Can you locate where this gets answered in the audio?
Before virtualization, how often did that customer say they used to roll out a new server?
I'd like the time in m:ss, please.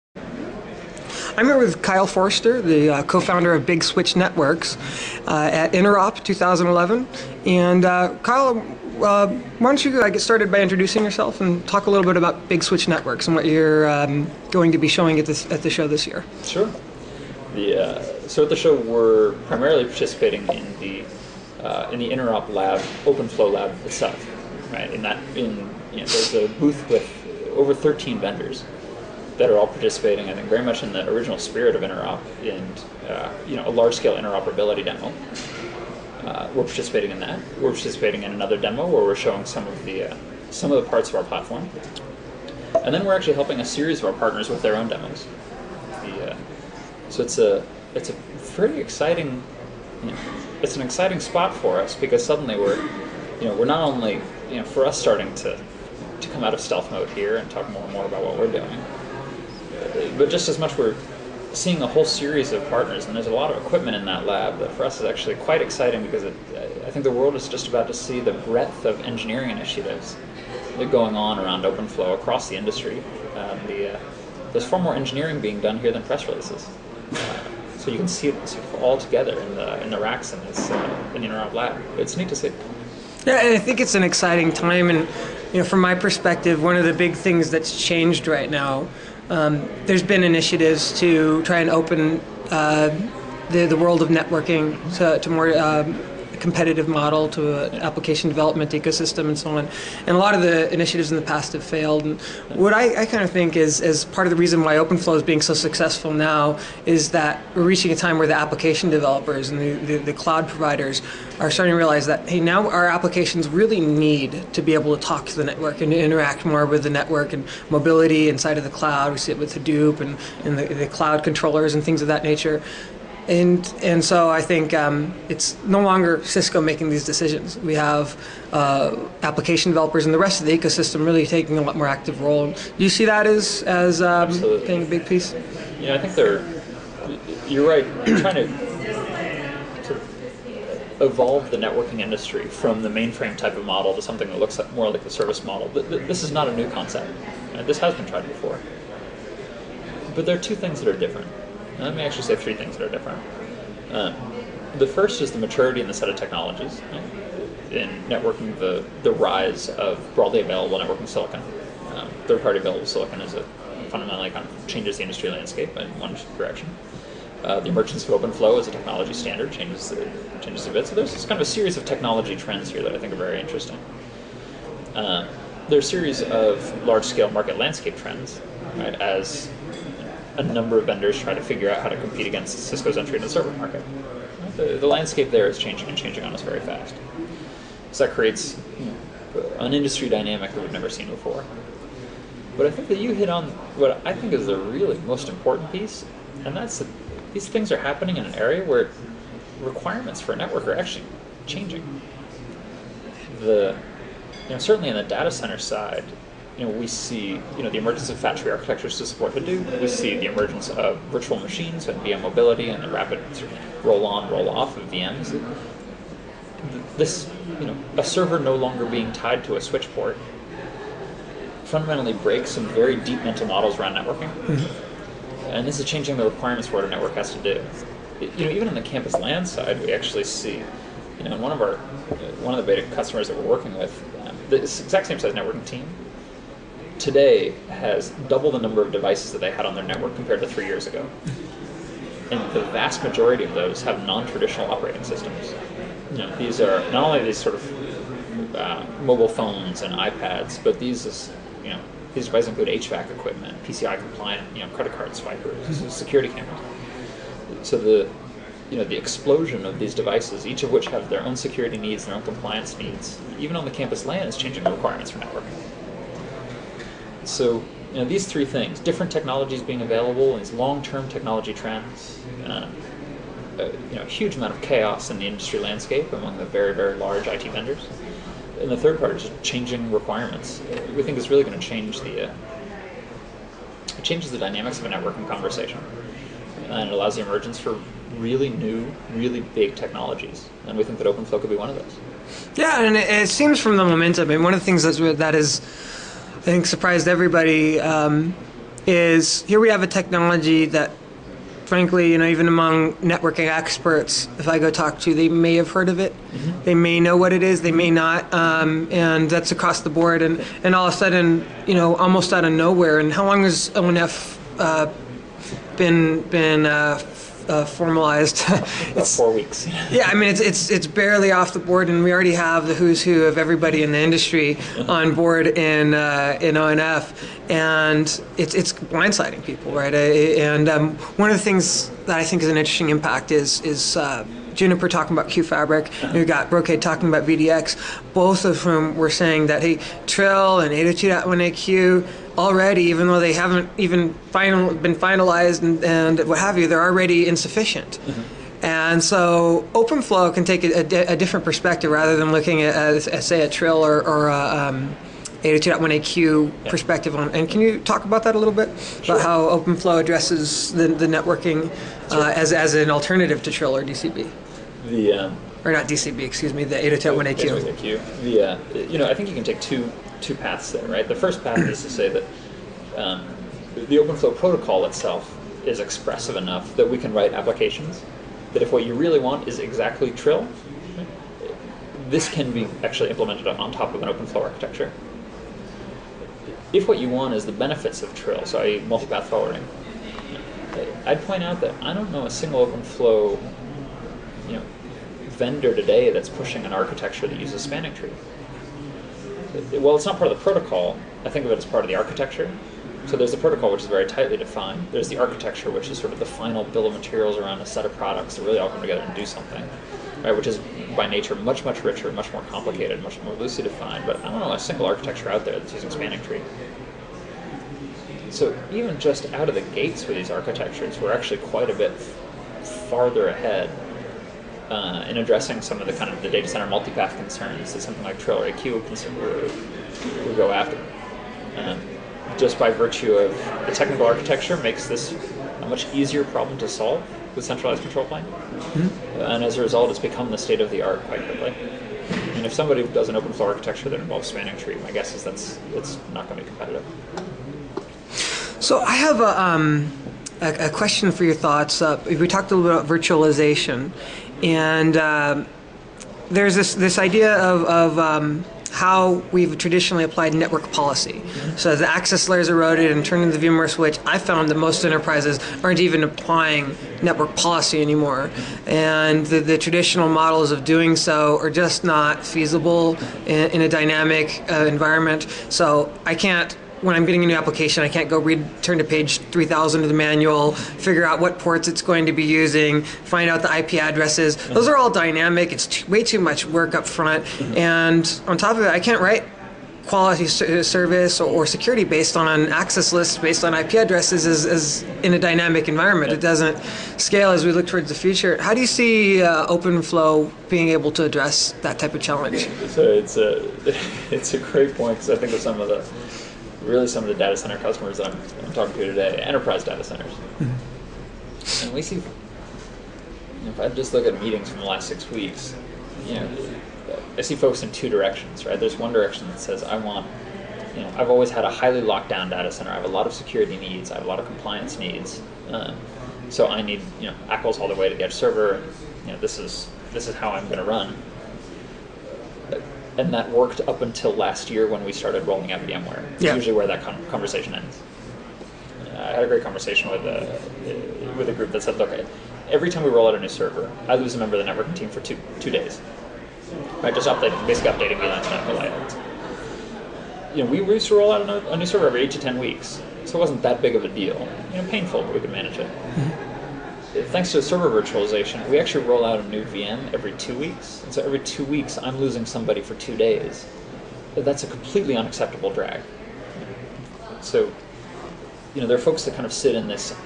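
9:12.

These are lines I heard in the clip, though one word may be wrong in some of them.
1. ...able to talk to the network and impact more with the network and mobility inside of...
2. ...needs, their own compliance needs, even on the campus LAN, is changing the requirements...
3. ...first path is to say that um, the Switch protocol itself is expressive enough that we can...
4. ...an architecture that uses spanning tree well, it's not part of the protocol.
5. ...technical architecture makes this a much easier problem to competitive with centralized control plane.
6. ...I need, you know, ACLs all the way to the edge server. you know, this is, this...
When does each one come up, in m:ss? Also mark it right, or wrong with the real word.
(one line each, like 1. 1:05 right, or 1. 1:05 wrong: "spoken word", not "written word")
1. 1:54 wrong: "interact", not "impact"
2. 4:21 right
3. 6:11 wrong: "OpenFlow", not "Switch"
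4. 6:36 right
5. 7:13 wrong: "solve", not "competitive"
6. 8:46 right.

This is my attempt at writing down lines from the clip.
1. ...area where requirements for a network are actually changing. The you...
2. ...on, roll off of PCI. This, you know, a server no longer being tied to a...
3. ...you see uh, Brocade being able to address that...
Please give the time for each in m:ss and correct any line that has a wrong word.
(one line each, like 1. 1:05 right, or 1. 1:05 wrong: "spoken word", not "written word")
1. 3:18 right
2. 3:34 wrong: "VMs", not "PCI"
3. 8:18 wrong: "OpenFlow", not "Brocade".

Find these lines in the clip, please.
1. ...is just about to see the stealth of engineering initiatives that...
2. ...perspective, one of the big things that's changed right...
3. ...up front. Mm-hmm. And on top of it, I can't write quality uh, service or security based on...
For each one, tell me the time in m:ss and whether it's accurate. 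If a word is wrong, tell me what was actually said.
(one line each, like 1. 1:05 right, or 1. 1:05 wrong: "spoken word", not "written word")
1. 1:07 wrong: "breadth", not "stealth"
2. 1:25 right
3. 8:06 right.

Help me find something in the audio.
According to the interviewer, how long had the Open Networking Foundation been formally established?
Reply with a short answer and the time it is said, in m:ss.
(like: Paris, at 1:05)
four weeks, at 5:19.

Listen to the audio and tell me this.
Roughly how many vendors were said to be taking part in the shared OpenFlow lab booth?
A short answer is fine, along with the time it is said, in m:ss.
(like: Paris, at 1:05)
13, at 0:27.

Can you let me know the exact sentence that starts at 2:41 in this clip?
Um, third party available silicon is a fundamentally kind of changes the industry landscape in one direction.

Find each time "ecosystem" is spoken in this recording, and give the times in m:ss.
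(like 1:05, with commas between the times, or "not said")
1:38, 2:10.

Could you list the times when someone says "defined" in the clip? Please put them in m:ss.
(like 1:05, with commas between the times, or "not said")
6:44, 6:53.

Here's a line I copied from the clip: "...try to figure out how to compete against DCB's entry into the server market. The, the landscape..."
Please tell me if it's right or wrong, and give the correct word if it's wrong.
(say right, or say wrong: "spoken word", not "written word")
wrong: "Cisco", not "DCB".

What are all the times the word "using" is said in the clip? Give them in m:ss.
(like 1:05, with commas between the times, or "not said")
6:55, 8:02.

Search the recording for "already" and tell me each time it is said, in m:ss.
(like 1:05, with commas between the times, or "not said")
5:22, 5:42, 5:46.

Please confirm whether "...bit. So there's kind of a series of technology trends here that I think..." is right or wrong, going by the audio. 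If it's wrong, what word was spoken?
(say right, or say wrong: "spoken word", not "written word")
right.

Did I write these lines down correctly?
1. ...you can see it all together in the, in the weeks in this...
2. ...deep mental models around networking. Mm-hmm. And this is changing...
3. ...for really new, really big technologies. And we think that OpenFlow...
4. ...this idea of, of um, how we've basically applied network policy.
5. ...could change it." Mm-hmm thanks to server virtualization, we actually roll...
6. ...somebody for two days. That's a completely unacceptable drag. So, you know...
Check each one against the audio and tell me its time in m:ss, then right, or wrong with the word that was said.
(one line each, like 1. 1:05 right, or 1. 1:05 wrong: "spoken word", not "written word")
1. 1:17 wrong: "racks", not "weeks"
2. 3:42 right
3. 4:47 right
4. 7:36 wrong: "traditionally", not "basically"
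5. 9:15 wrong: "manage", not "change"
6. 9:22 right.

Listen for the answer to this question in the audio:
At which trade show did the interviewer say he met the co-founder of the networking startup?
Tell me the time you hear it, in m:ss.
0:05.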